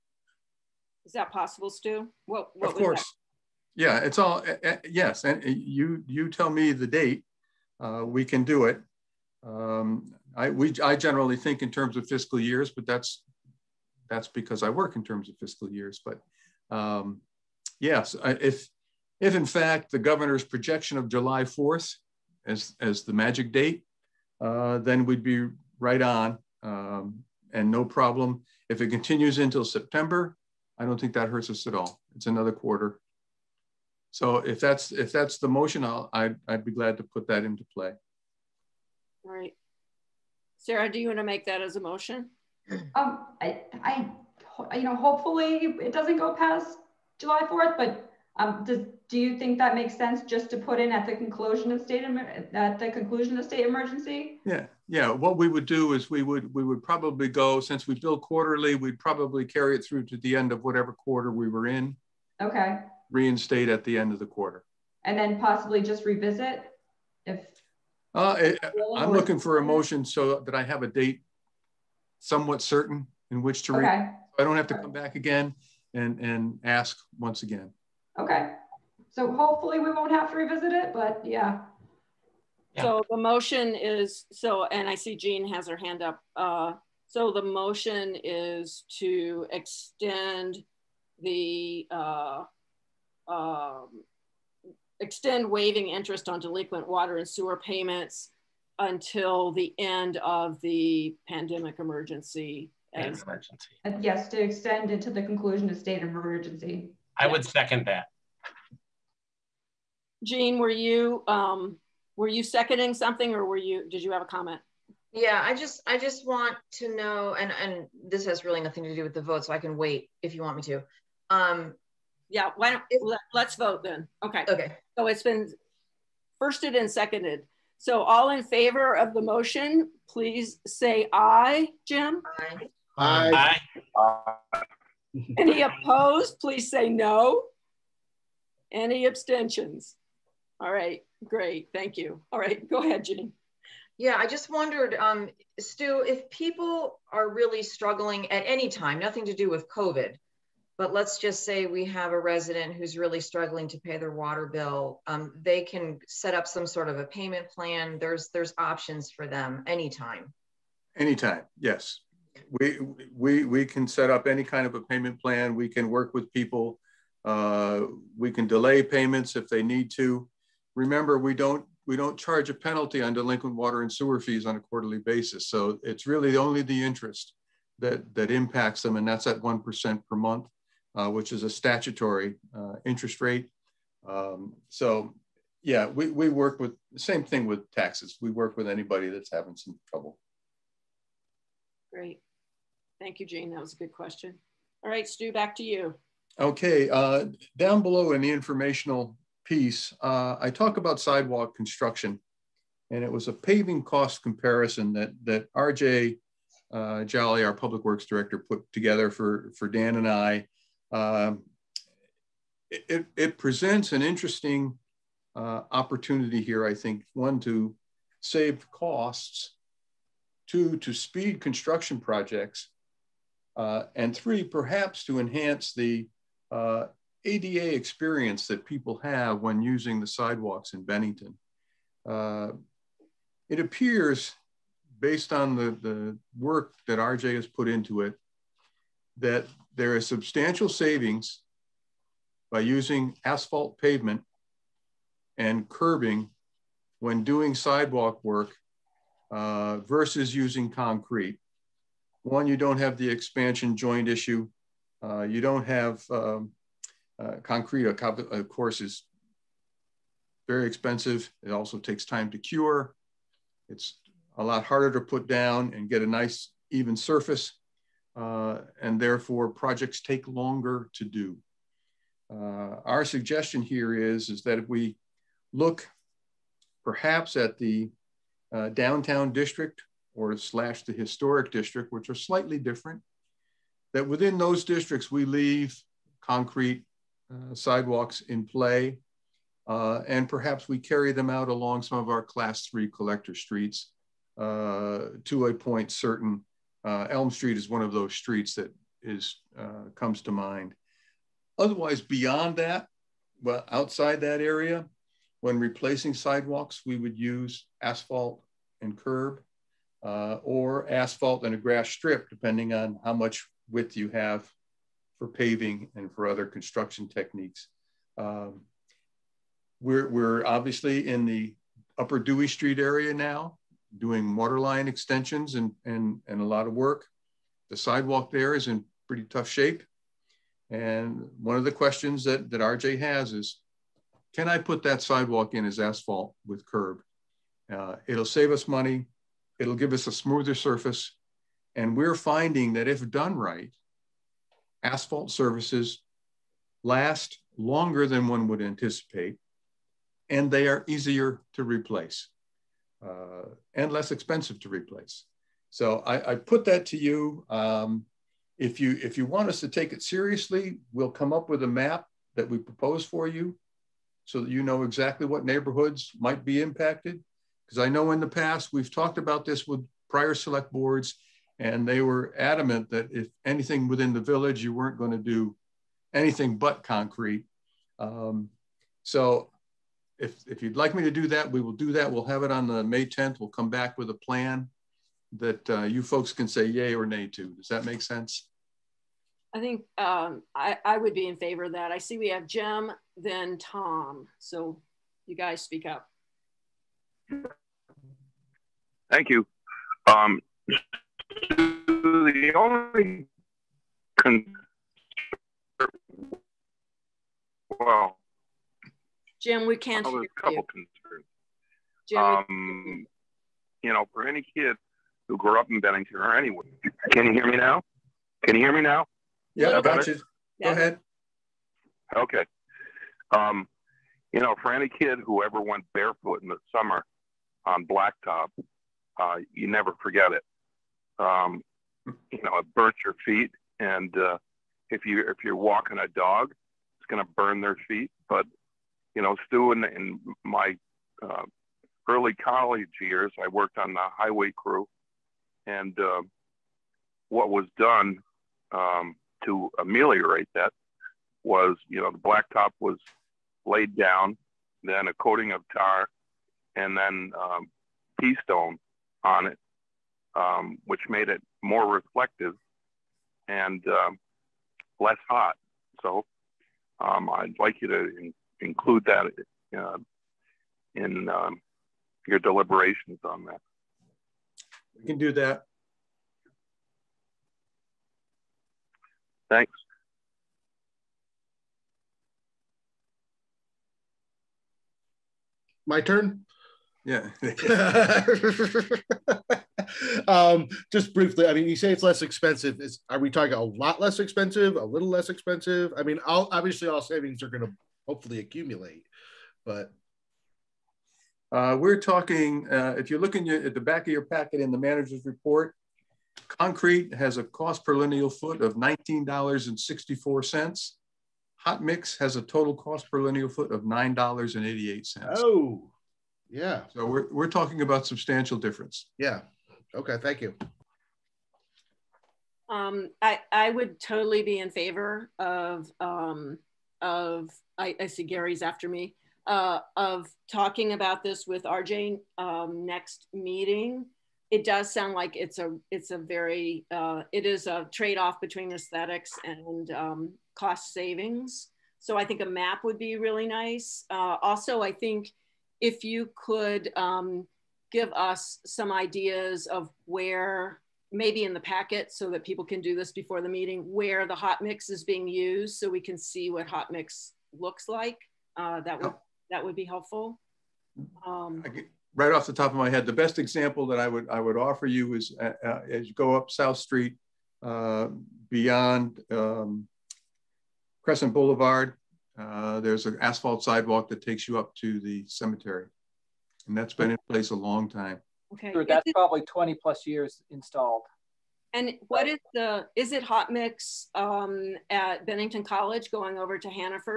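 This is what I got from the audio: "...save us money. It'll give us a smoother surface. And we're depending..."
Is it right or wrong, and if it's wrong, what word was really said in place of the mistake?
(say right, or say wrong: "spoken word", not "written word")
wrong: "finding", not "depending".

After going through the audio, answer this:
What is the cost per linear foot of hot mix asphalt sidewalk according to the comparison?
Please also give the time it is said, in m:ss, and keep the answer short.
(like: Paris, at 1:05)
$9.88, at 8:33.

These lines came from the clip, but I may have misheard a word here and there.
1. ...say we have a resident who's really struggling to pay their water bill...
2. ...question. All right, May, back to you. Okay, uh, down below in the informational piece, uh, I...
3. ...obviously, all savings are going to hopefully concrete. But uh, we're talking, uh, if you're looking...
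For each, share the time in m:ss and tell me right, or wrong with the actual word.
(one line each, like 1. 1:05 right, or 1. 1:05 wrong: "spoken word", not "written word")
1. 2:31 right
2. 3:13 wrong: "Stu", not "May"
3. 8:16 wrong: "accumulate", not "concrete".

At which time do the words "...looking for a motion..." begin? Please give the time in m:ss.
1:09.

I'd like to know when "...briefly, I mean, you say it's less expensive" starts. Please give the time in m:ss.
8:11.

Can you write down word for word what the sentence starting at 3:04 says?
Um, so yeah, we, we work with the same thing with taxes.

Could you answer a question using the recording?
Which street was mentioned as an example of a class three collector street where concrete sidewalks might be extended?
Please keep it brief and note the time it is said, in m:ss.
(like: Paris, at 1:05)
Elm Street, at 4:57.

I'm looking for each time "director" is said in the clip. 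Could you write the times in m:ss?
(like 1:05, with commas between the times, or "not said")
3:28.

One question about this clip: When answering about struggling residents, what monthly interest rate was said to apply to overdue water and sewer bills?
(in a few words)
1% per month.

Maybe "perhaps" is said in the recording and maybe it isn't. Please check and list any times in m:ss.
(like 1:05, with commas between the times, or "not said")
3:44, 4:36, 4:50.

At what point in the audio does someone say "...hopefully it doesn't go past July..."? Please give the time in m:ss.
0:44.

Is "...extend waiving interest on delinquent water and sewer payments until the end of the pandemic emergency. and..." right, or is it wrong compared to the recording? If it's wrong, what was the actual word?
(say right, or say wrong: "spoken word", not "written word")
right.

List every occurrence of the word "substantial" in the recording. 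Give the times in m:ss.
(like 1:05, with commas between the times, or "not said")
4:00, 8:38.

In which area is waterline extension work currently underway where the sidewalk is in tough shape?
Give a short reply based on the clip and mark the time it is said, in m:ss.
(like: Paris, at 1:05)
upper Dewey Street, at 5:21.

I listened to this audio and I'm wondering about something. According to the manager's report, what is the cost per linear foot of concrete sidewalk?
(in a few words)
$19.64.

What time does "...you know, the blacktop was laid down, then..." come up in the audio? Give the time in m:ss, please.
7:31.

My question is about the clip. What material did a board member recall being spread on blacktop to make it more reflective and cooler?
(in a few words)
pea stone.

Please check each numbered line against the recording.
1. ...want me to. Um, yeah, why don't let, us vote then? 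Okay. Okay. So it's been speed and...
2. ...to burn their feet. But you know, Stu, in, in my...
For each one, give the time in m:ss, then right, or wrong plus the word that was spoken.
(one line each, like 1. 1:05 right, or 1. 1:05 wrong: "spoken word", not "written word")
1. 2:00 wrong: "firsted", not "speed"
2. 7:17 right.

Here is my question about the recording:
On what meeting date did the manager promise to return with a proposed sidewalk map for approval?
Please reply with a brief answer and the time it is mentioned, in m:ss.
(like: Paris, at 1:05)
May 10th, at 6:22.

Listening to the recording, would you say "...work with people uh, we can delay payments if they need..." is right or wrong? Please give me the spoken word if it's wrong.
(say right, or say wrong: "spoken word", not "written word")
right.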